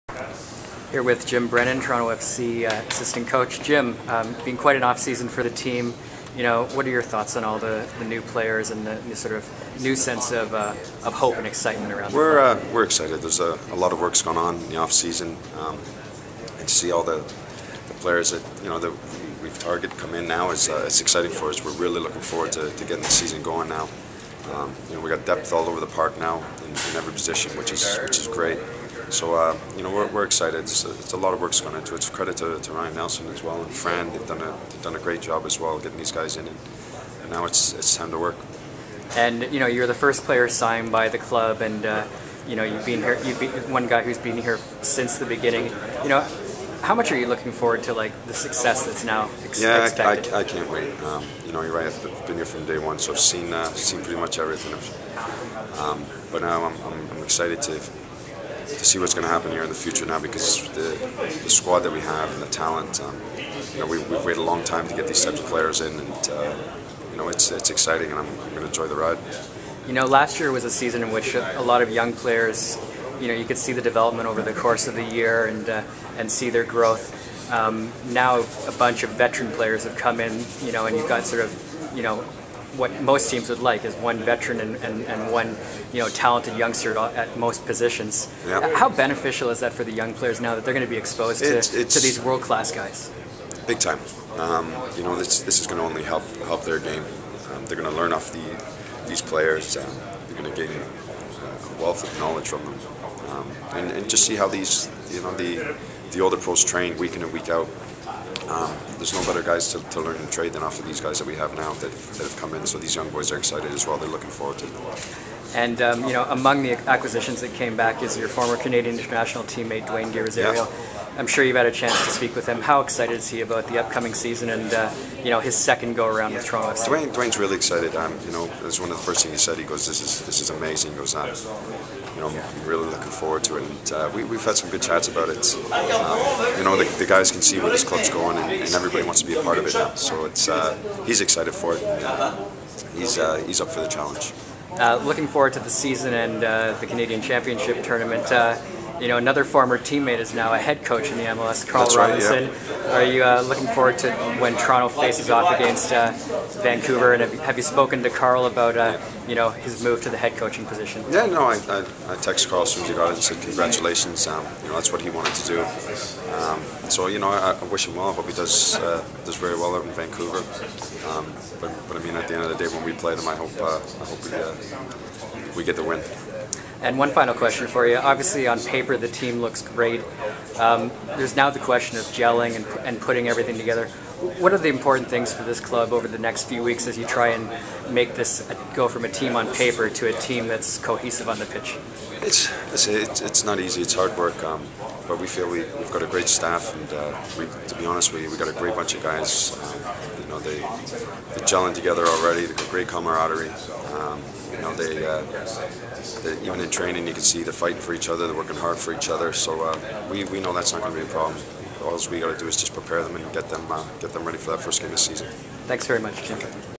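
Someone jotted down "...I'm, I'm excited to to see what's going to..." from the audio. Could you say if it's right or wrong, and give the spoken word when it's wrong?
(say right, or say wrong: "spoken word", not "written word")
right.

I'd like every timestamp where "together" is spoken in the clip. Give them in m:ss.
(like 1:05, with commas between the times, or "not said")
3:03, 3:21.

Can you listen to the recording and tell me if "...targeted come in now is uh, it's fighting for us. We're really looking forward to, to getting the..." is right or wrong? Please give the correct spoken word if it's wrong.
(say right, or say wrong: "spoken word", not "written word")
wrong: "exciting", not "fighting".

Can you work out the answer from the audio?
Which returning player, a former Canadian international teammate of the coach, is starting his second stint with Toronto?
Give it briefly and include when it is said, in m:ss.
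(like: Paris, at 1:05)
Dwayne De Rosario, at 1:59.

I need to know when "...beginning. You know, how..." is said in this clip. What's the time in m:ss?
0:45.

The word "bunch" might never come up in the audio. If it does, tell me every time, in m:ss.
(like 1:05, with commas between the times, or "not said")
1:18, 3:18.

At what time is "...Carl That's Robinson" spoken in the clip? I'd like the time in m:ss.
2:31.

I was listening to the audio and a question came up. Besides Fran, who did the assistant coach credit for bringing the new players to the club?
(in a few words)
Ryan Nelsen.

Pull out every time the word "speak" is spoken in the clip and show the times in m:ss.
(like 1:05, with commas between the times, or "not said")
2:02.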